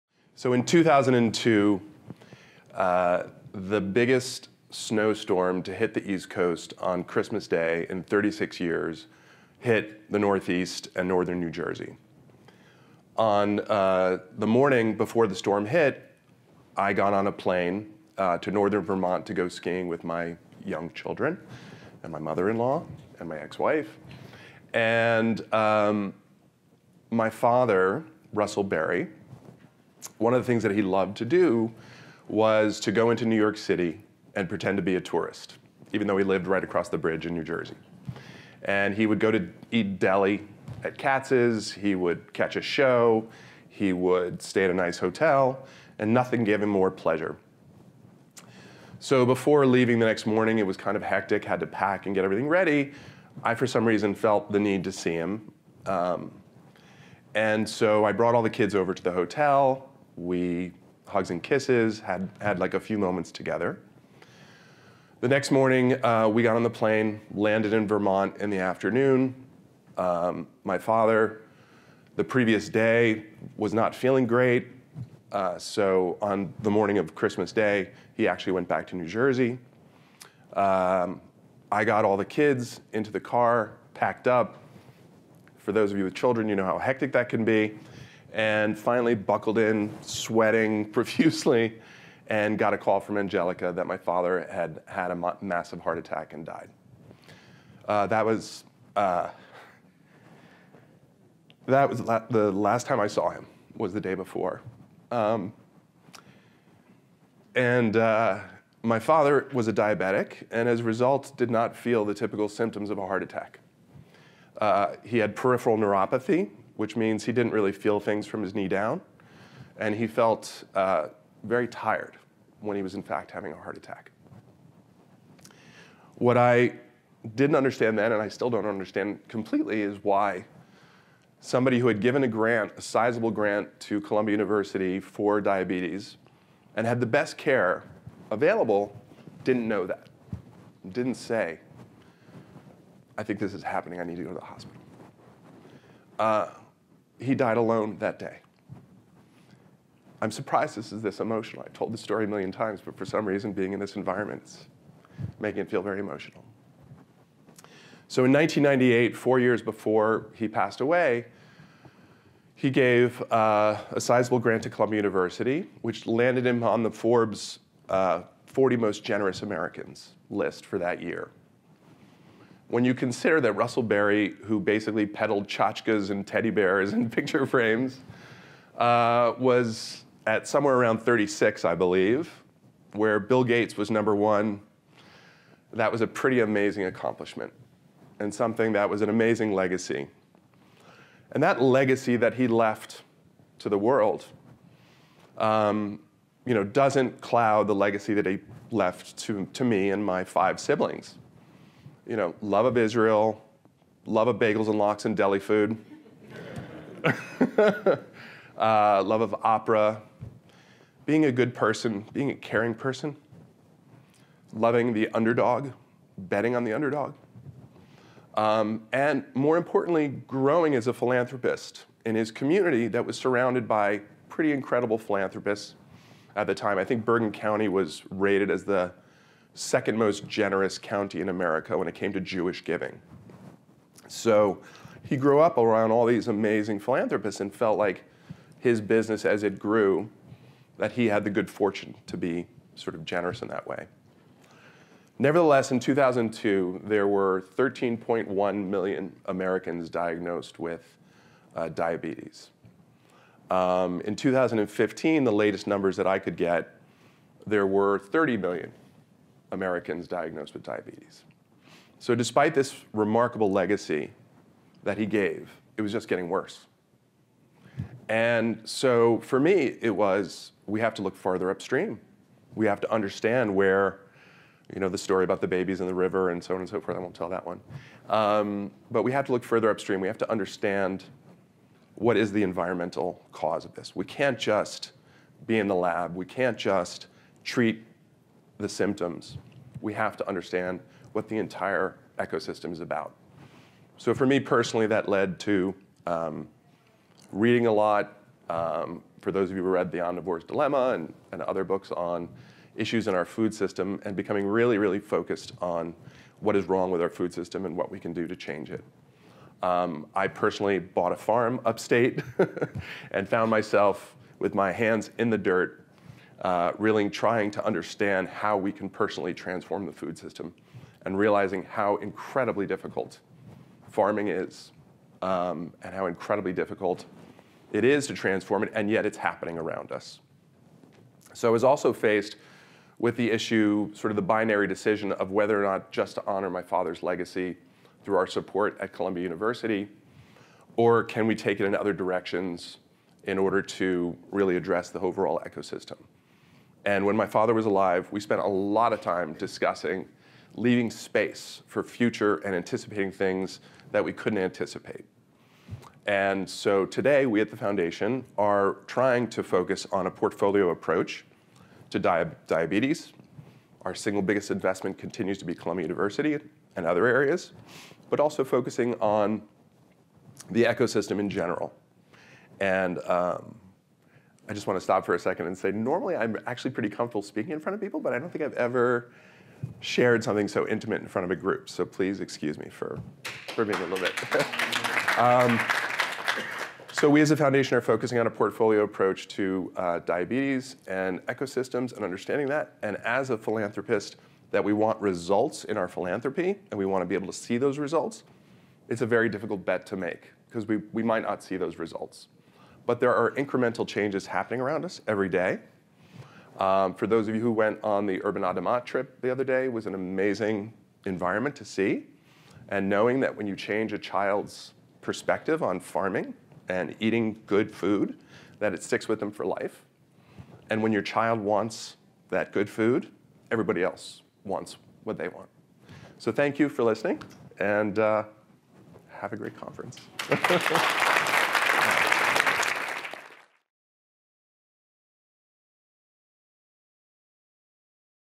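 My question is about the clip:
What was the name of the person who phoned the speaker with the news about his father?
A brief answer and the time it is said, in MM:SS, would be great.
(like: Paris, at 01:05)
Angelica, at 01:33.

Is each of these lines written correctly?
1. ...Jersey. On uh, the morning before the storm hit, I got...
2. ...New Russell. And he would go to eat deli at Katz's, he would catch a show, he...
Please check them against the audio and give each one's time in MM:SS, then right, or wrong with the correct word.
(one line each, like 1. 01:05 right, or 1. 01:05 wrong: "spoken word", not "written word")
1. 00:11 right
2. 00:37 wrong: "Jersey", not "Russell".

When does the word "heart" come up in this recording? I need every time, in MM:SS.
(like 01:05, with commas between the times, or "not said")
01:35, 01:53, 02:03.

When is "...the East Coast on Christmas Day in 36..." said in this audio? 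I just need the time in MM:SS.
00:05.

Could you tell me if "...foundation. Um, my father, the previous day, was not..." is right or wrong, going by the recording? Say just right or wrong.
wrong.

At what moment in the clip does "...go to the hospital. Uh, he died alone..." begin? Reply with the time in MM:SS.
02:24.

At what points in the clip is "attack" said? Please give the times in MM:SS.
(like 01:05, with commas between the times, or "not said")
01:35, 01:53, 02:03.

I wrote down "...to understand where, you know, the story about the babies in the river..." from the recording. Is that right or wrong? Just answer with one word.
right.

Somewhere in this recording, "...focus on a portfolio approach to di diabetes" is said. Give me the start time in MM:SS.
05:59.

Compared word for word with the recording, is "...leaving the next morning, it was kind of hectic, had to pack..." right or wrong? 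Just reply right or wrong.
right.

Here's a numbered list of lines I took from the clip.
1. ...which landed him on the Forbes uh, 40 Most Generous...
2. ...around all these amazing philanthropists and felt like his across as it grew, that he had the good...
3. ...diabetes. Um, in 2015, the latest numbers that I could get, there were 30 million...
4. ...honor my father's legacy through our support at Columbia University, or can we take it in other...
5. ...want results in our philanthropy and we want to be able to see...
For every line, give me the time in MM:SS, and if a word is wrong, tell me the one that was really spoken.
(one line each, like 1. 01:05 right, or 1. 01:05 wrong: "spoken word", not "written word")
1. 02:45 right
2. 03:55 wrong: "business", not "across"
3. 04:11 right
4. 05:36 right
5. 06:34 right.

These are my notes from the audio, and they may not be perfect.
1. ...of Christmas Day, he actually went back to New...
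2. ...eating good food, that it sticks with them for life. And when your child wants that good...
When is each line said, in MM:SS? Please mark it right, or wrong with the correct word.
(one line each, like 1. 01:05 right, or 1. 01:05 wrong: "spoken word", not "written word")
1. 01:16 right
2. 06:56 right.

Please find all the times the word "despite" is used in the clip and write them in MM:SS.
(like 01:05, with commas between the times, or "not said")
04:22.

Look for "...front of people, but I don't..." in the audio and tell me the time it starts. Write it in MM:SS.
06:17.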